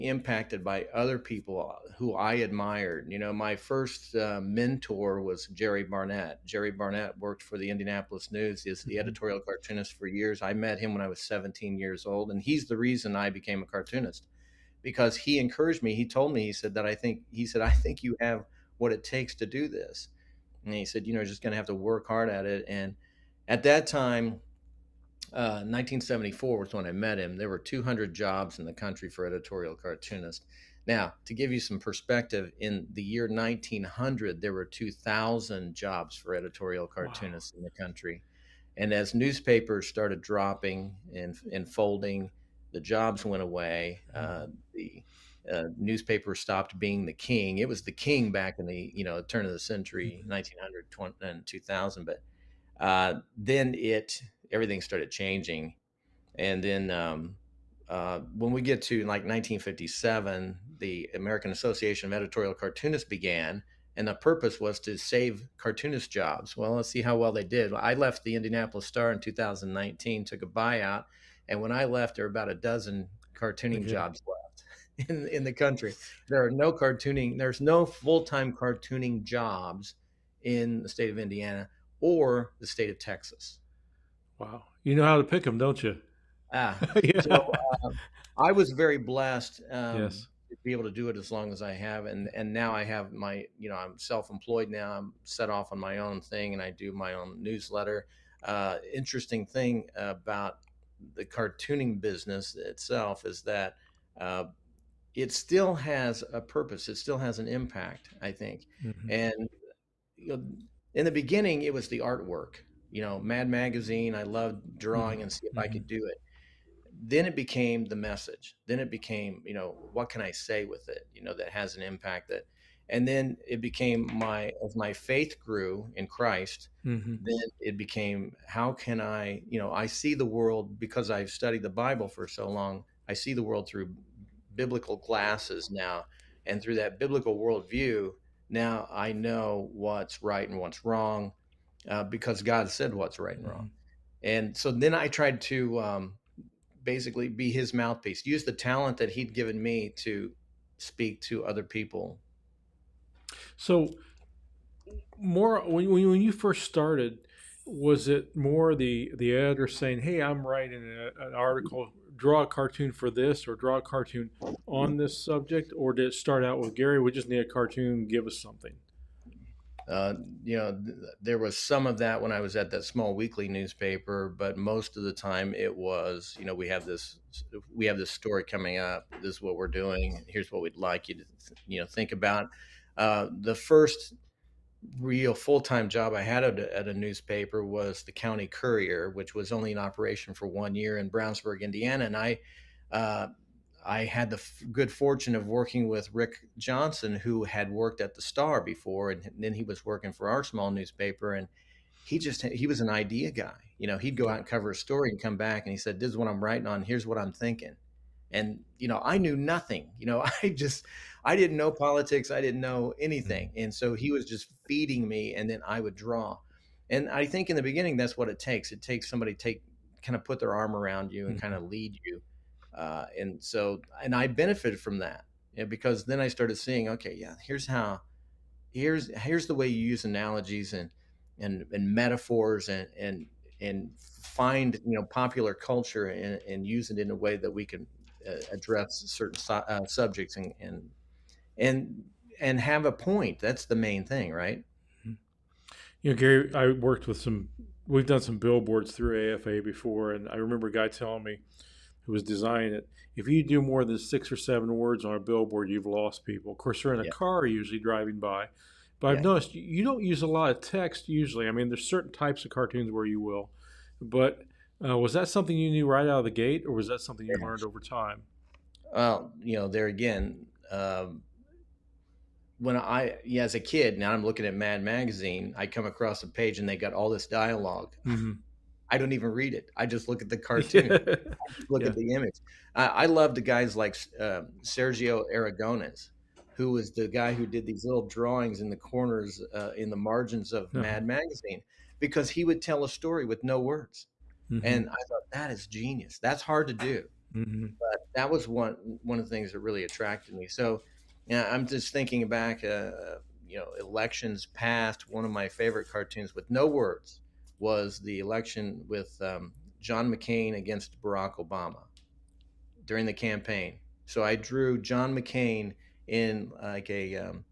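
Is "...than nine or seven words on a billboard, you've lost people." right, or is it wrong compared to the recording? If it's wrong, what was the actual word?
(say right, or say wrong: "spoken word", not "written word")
wrong: "six", not "nine".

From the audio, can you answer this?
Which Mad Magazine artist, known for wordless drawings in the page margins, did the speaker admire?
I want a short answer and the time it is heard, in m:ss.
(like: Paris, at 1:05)
Sergio Aragones, at 4:44.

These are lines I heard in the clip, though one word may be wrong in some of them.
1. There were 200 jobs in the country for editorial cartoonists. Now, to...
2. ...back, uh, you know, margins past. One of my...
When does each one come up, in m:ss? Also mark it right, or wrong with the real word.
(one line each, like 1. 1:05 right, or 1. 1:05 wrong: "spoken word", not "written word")
1. 0:27 right
2. 5:02 wrong: "elections", not "margins".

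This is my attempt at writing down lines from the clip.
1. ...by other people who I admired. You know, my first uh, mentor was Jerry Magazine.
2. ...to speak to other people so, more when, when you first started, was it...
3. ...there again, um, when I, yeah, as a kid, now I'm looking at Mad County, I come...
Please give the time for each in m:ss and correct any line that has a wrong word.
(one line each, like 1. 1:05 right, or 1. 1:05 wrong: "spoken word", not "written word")
1. 0:00 wrong: "Barnett", not "Magazine"
2. 2:29 right
3. 4:29 wrong: "Magazine", not "County".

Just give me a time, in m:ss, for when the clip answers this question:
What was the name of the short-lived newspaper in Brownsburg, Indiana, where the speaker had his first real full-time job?
3:08.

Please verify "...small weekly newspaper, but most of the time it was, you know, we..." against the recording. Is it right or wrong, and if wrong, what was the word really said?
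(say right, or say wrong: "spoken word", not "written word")
right.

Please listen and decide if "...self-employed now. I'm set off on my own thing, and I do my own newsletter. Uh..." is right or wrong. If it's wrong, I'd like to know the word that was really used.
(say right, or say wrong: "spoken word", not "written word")
right.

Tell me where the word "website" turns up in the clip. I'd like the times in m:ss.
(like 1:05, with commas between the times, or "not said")
not said.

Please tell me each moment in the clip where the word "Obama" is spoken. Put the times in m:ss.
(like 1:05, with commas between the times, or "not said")
5:11.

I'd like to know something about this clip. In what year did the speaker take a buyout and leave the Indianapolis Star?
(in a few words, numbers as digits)
2019.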